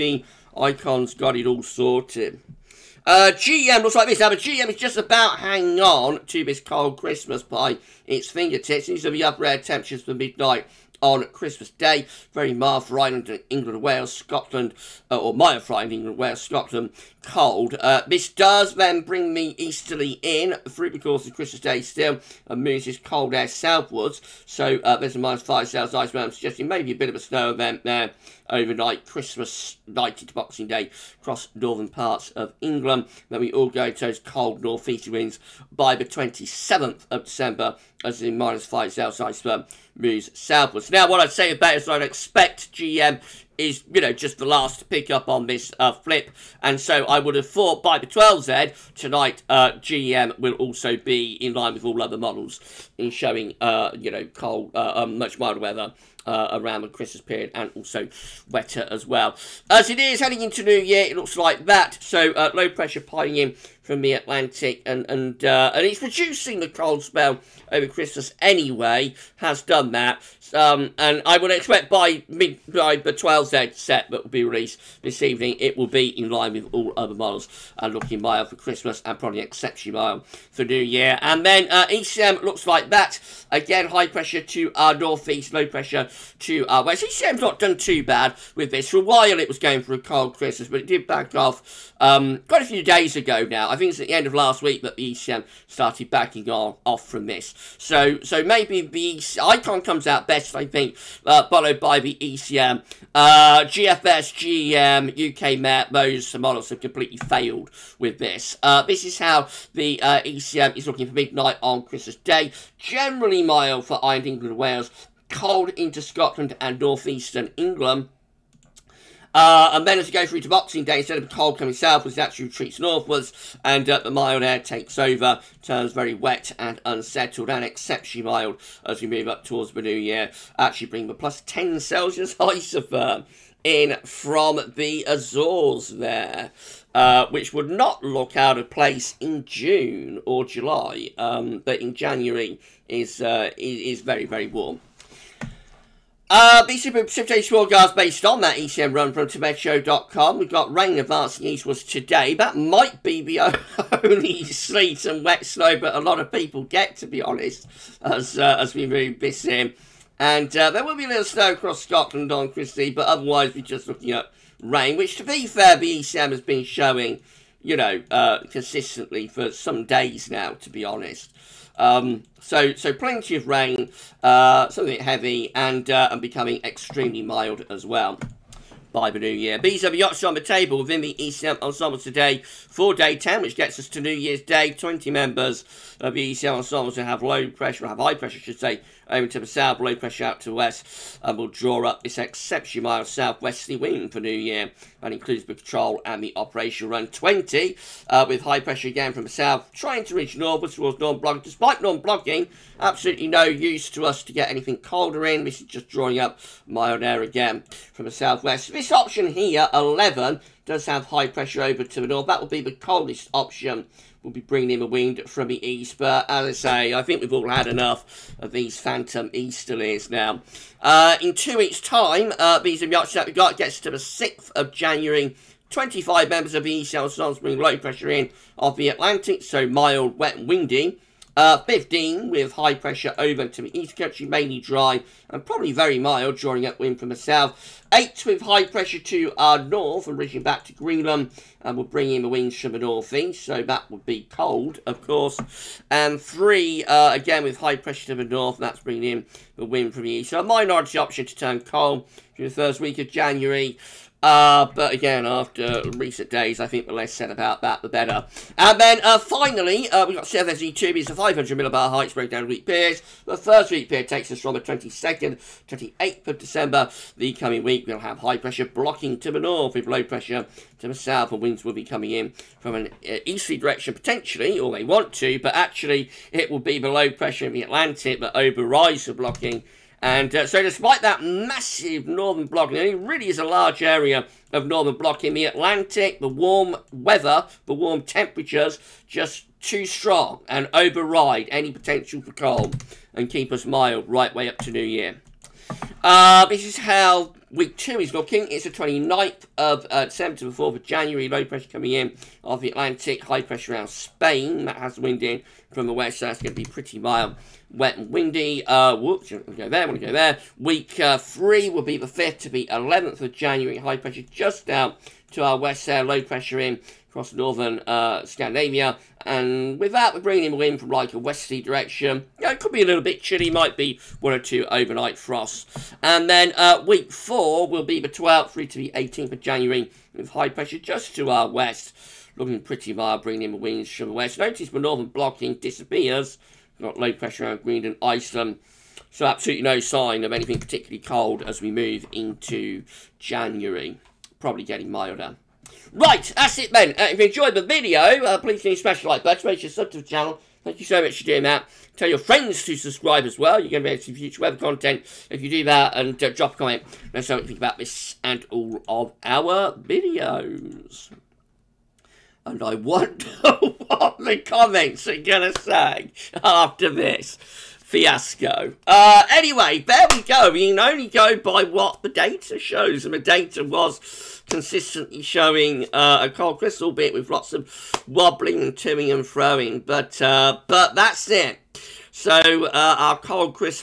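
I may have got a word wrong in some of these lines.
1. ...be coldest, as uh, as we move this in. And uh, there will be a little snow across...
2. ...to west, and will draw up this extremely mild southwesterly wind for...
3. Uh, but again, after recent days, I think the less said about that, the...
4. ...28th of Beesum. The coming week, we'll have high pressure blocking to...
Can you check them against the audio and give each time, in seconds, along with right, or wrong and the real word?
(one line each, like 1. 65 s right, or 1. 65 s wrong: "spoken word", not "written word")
1. 157 s wrong: "honest", not "coldest"
2. 190 s wrong: "exceptionally", not "extremely"
3. 254 s right
4. 265 s wrong: "December", not "Beesum".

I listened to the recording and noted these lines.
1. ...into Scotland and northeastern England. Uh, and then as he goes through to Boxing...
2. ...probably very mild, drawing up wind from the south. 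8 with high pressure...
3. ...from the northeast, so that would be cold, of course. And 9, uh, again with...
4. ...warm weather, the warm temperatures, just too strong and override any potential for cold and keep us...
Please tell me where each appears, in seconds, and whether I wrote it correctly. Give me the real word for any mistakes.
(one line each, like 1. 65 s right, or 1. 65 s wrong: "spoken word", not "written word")
1. 115 s right
2. 235 s right
3. 242 s wrong: "3", not "9"
4. 286 s right.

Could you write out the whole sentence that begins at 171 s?
Um, so, so plenty of rain, uh, something heavy, and, uh, and becoming extremely mild as well by the new year.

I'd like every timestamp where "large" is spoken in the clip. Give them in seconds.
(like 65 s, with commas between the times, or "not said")
283 s.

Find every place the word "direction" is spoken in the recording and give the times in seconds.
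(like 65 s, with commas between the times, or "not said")
273 s, 321 s.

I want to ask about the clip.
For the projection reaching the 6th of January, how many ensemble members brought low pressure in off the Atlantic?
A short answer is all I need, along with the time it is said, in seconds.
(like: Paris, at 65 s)
25, at 225 s.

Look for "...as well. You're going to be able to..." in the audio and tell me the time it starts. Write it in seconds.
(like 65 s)
353 s.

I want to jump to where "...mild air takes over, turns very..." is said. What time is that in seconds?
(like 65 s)
124 s.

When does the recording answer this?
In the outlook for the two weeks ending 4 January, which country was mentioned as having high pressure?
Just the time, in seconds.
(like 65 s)
303 s.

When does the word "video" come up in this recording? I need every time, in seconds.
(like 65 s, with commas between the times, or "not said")
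347 s, 359 s.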